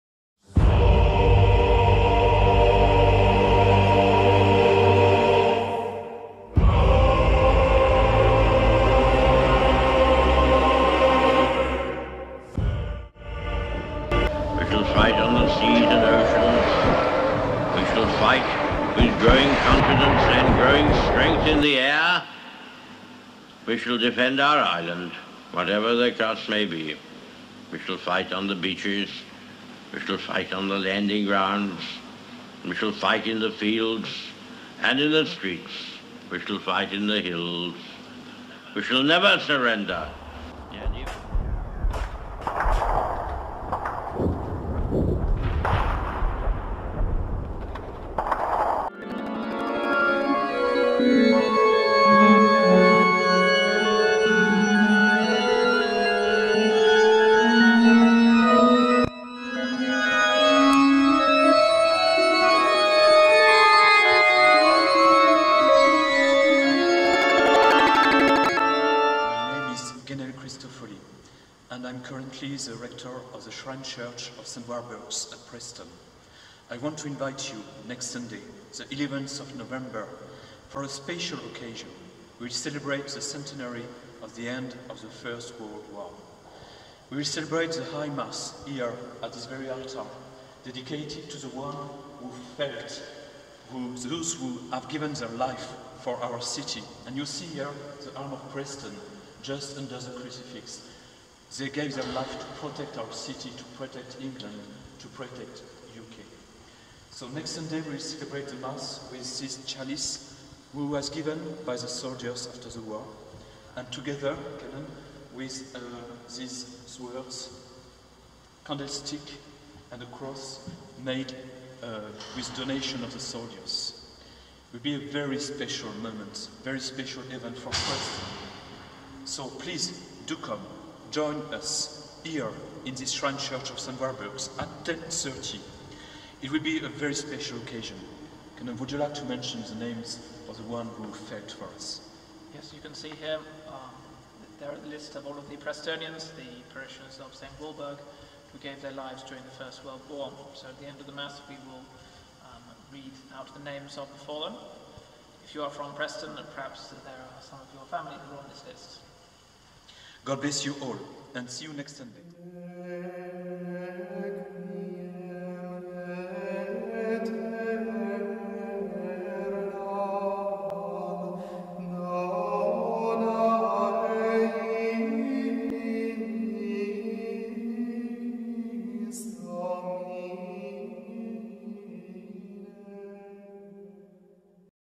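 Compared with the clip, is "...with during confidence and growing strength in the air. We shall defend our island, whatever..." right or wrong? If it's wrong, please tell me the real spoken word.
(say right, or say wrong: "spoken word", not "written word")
wrong: "growing", not "during".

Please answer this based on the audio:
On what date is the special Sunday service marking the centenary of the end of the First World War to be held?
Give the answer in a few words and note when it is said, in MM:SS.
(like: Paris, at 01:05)
11th of November, at 01:18.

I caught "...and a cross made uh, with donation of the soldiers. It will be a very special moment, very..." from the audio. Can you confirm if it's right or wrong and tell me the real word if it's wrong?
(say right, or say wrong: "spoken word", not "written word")
right.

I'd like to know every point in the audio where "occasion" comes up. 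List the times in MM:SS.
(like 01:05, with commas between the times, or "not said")
01:21, 02:17.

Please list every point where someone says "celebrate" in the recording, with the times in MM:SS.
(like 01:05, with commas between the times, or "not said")
01:22, 01:27, 01:47.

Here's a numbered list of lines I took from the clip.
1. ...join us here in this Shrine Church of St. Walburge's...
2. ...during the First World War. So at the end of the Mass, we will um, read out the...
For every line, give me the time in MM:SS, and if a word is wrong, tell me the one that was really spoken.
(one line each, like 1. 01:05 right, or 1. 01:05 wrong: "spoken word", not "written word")
1. 02:11 right
2. 02:29 right.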